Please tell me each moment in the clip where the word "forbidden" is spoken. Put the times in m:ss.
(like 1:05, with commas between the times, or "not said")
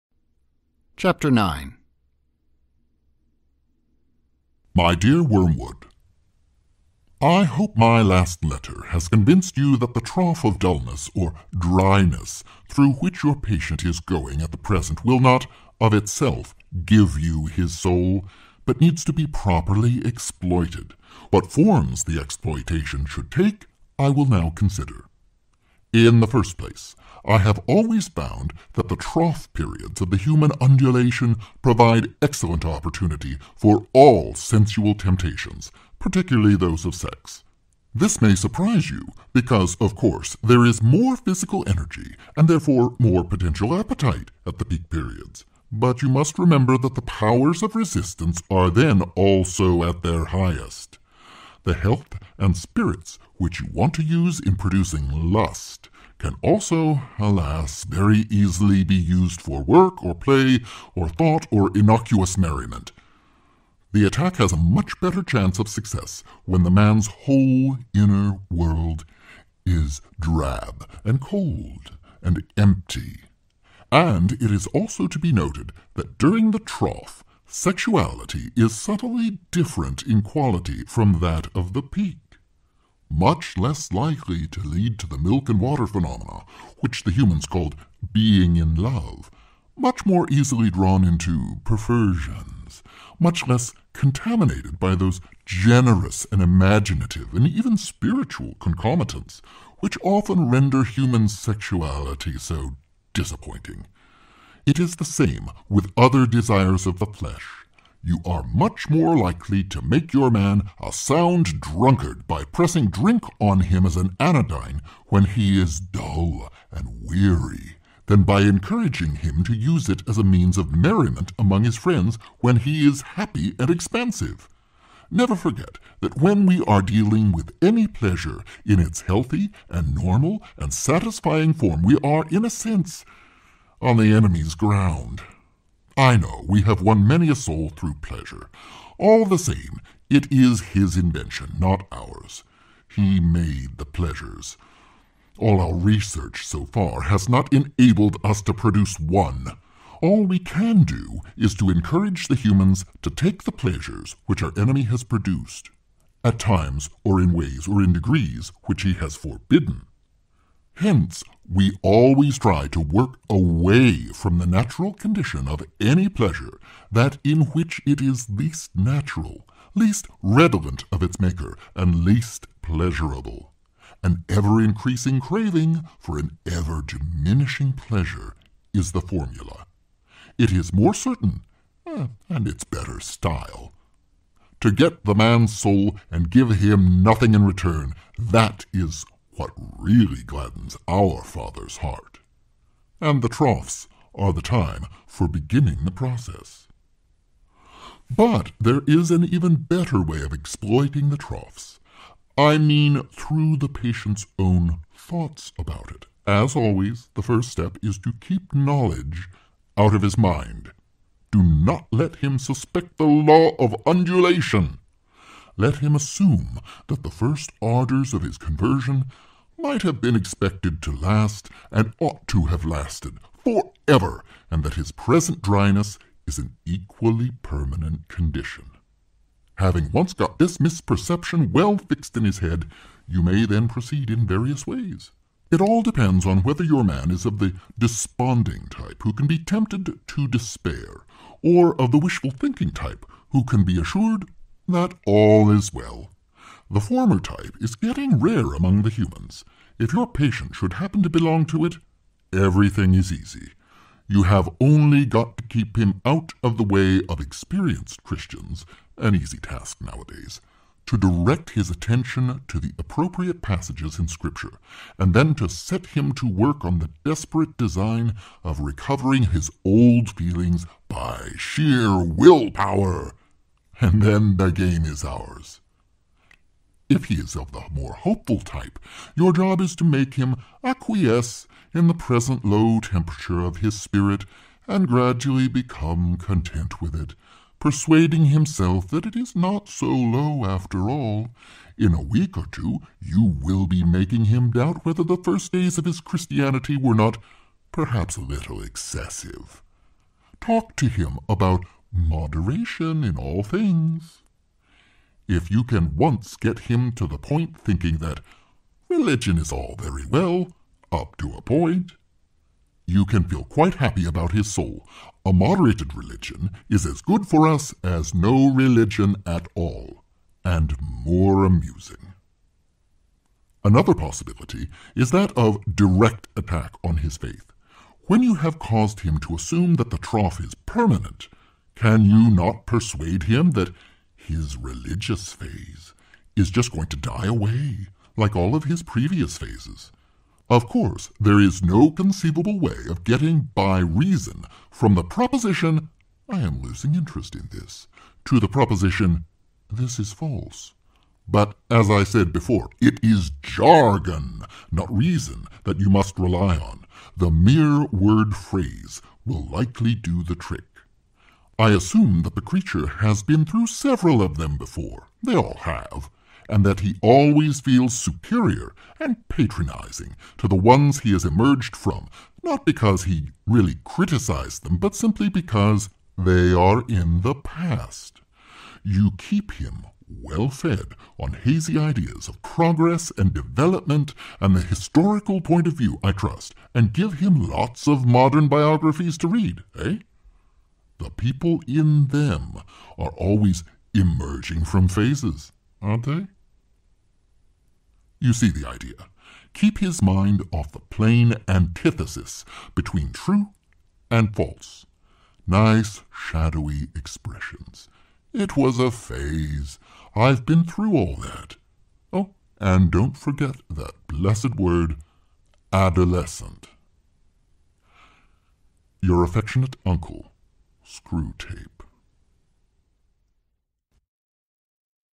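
2:39.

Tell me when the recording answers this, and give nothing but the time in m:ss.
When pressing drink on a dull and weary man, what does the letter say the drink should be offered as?
1:53.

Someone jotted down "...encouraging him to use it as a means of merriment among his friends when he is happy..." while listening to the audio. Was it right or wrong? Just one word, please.
right.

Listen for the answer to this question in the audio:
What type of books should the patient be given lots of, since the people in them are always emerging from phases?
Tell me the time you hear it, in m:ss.
6:28.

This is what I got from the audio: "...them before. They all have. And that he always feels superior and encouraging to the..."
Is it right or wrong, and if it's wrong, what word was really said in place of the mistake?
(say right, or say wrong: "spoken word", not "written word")
wrong: "patronizing", not "encouraging".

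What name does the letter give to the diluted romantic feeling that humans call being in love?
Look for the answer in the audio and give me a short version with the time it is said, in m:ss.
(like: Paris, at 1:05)
milk and water phenomena, at 1:25.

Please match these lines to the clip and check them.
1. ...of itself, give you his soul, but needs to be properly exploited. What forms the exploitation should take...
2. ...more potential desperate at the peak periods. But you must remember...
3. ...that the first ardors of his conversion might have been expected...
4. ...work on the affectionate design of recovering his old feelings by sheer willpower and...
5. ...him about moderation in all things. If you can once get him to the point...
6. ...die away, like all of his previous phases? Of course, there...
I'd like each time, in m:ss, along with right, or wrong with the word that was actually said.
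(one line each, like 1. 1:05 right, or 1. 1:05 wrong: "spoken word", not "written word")
1. 0:15 right
2. 0:42 wrong: "appetite", not "desperate"
3. 3:36 right
4. 4:26 wrong: "desperate", not "affectionate"
5. 5:00 right
6. 5:36 right.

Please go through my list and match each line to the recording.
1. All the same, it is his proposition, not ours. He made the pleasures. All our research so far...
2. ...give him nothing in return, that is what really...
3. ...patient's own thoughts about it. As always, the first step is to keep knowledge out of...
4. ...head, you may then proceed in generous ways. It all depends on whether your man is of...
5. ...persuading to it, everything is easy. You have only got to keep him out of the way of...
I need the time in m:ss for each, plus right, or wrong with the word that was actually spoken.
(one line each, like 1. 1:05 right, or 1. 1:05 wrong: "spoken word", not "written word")
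1. 2:18 wrong: "invention", not "proposition"
2. 3:06 right
3. 3:23 right
4. 3:52 wrong: "various", not "generous"
5. 4:11 wrong: "belong", not "persuading".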